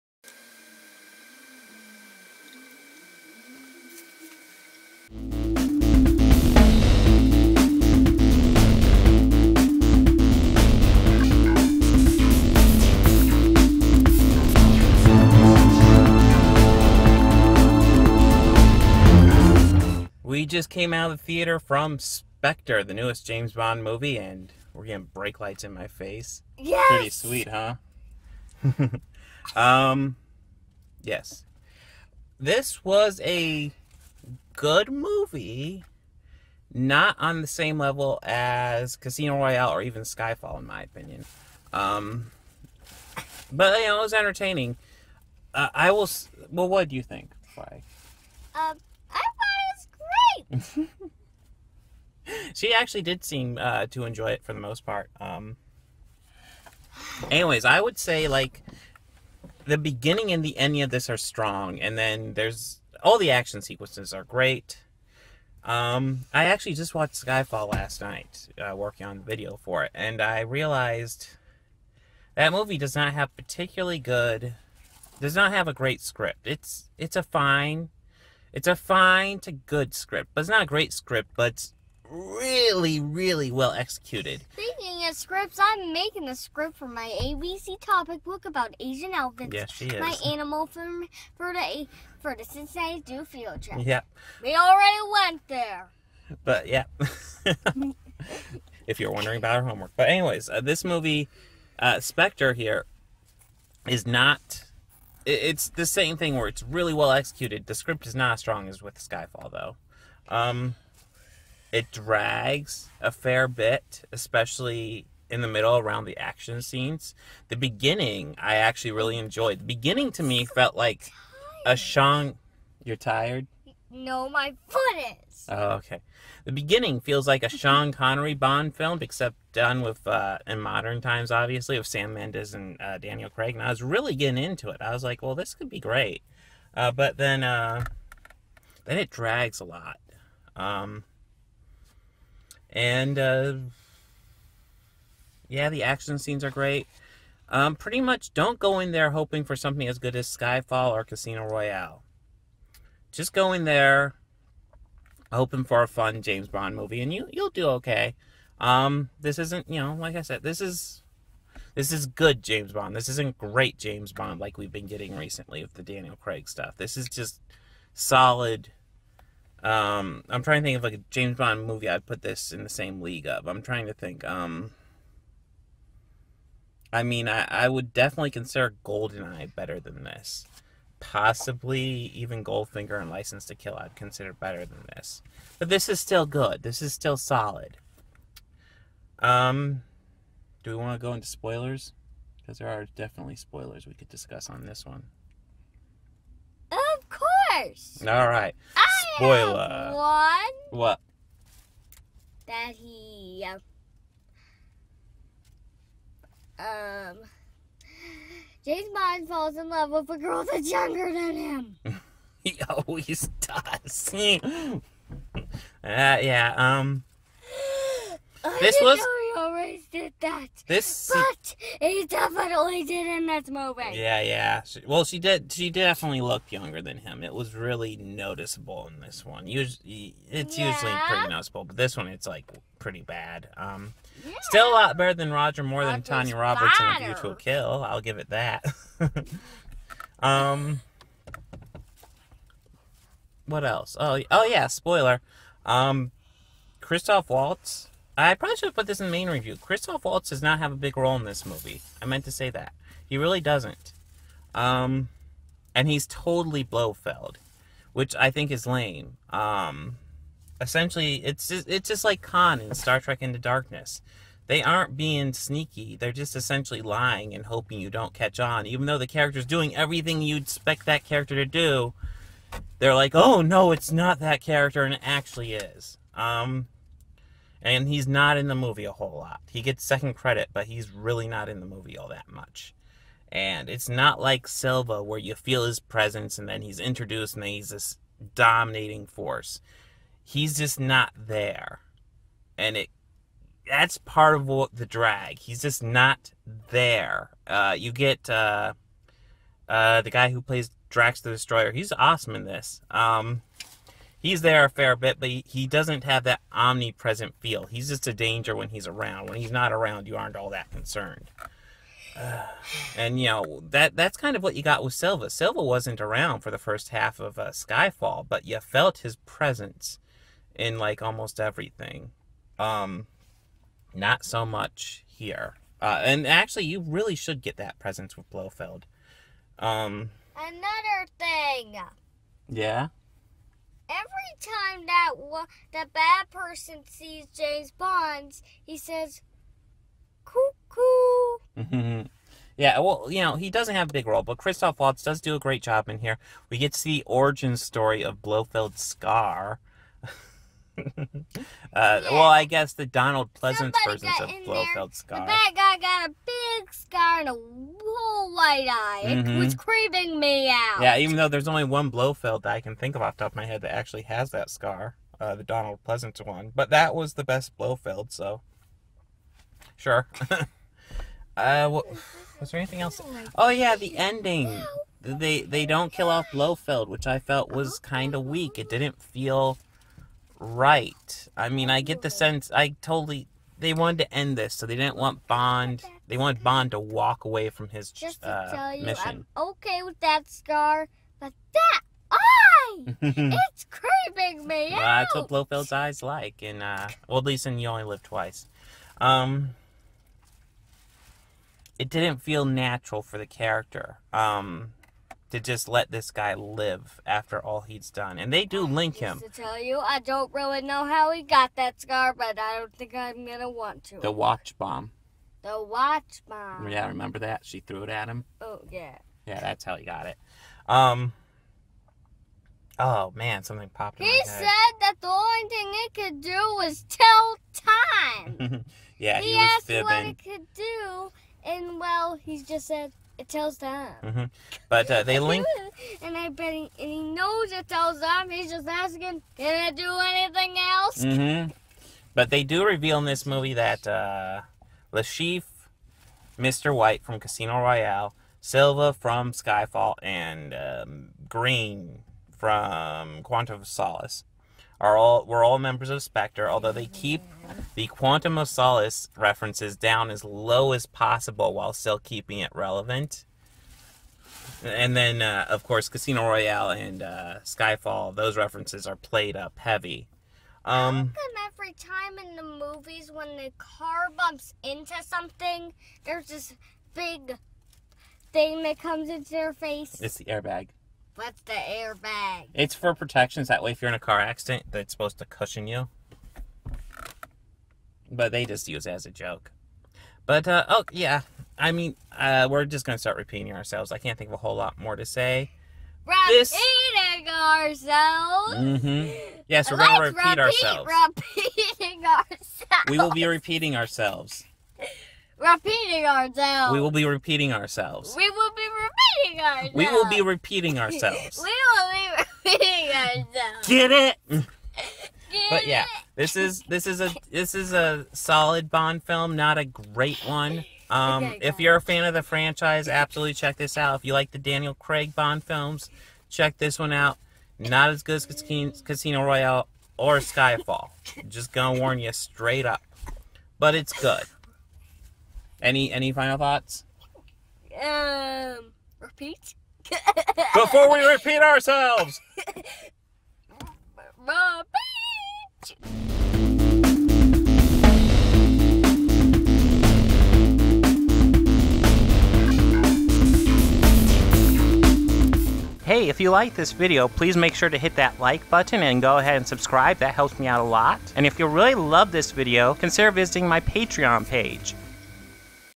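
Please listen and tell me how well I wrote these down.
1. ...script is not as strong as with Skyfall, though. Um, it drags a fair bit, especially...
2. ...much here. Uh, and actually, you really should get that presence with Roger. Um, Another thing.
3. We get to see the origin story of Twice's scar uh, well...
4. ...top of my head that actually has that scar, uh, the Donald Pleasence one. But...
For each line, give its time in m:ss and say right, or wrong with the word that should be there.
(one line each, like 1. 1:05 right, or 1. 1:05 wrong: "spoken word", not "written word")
1. 1:47 right
2. 5:24 wrong: "Blofeld", not "Roger"
3. 5:46 wrong: "Blofeld", not "Twice"
4. 6:03 right.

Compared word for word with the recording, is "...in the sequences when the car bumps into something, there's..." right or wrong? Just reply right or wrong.
wrong.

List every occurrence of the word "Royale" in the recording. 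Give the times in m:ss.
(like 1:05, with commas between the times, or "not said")
0:39, 2:31, 7:27, 7:46, 8:49.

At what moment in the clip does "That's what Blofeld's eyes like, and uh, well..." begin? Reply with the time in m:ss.
6:35.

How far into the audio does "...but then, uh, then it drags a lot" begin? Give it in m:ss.
2:16.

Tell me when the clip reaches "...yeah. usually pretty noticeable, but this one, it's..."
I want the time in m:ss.
3:50.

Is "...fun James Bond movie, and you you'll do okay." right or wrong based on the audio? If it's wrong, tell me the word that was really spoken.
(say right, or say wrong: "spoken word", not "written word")
right.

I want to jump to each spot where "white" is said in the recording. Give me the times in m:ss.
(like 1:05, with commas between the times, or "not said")
5:58, 7:26.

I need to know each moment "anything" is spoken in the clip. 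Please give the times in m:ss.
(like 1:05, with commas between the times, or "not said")
6:12, 7:20.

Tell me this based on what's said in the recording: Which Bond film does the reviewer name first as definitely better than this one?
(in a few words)
Goldeneye.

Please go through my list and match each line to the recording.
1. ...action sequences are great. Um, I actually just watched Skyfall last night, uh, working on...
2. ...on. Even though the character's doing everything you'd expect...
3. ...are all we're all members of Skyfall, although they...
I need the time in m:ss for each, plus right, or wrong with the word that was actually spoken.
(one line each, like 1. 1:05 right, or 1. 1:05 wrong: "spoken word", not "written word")
1. 1:03 right
2. 4:28 right
3. 7:34 wrong: "Spectre", not "Skyfall".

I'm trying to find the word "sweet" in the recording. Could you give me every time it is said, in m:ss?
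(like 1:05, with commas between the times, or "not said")
0:27.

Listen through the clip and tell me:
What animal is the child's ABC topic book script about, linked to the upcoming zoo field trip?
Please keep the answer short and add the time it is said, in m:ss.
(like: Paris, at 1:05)
Asian elephants, at 1:28.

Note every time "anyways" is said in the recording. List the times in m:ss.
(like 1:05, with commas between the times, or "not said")
0:57, 1:40.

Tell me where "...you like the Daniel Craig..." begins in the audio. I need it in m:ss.
8:44.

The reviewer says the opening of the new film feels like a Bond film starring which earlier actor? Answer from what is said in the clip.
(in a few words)
Sean Connery.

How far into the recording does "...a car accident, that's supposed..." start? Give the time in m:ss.
8:03.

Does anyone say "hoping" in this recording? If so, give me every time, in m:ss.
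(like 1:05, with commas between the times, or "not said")
2:29, 2:35, 4:27.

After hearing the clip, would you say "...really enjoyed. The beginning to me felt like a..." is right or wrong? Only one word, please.
right.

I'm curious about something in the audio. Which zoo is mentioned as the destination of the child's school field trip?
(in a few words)
Cincinnati Zoo.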